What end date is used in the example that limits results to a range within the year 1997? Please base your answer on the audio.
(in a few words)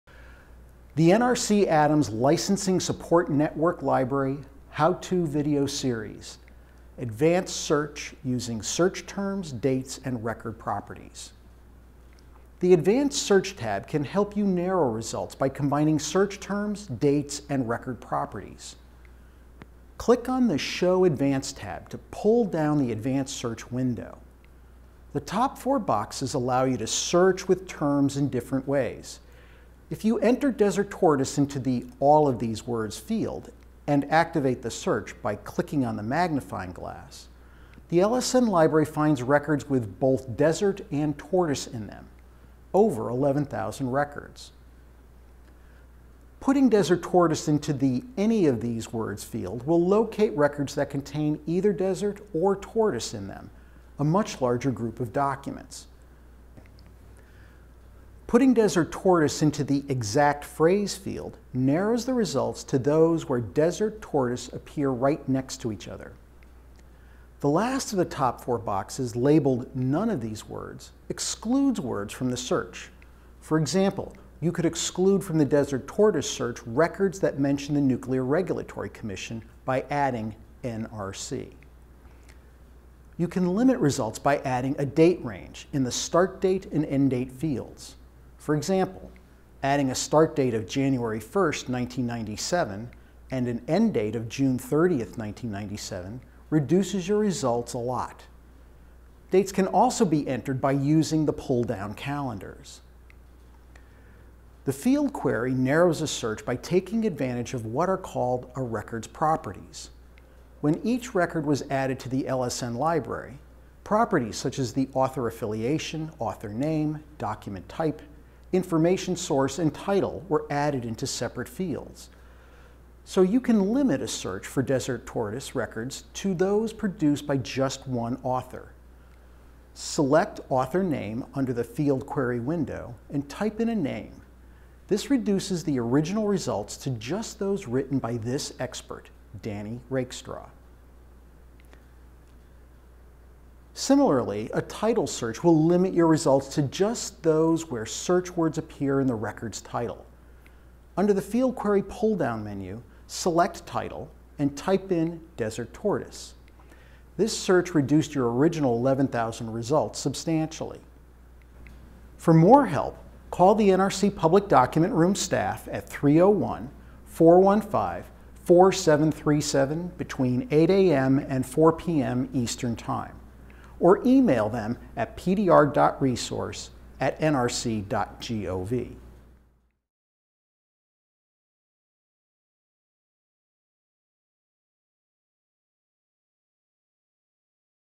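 June 30, 1997.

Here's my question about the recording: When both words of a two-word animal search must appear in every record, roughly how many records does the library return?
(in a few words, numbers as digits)
over 11,000.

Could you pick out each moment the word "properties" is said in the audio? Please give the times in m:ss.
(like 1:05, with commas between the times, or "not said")
0:10, 0:18, 1:49, 1:53.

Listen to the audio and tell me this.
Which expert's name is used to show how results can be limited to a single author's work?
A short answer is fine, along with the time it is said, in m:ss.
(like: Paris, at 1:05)
Danny Rakestraw, at 2:19.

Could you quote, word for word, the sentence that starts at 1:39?
Dates can also be entered by using the pull-down calendars.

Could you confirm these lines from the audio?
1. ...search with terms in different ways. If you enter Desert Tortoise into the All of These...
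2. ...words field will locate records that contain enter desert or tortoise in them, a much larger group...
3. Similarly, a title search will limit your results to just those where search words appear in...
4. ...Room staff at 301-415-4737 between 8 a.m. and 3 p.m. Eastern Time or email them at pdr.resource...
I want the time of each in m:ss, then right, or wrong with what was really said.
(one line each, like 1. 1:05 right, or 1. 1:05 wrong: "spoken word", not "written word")
1. 0:26 right
2. 0:48 wrong: "either", not "enter"
3. 2:23 right
4. 2:44 wrong: "4", not "3".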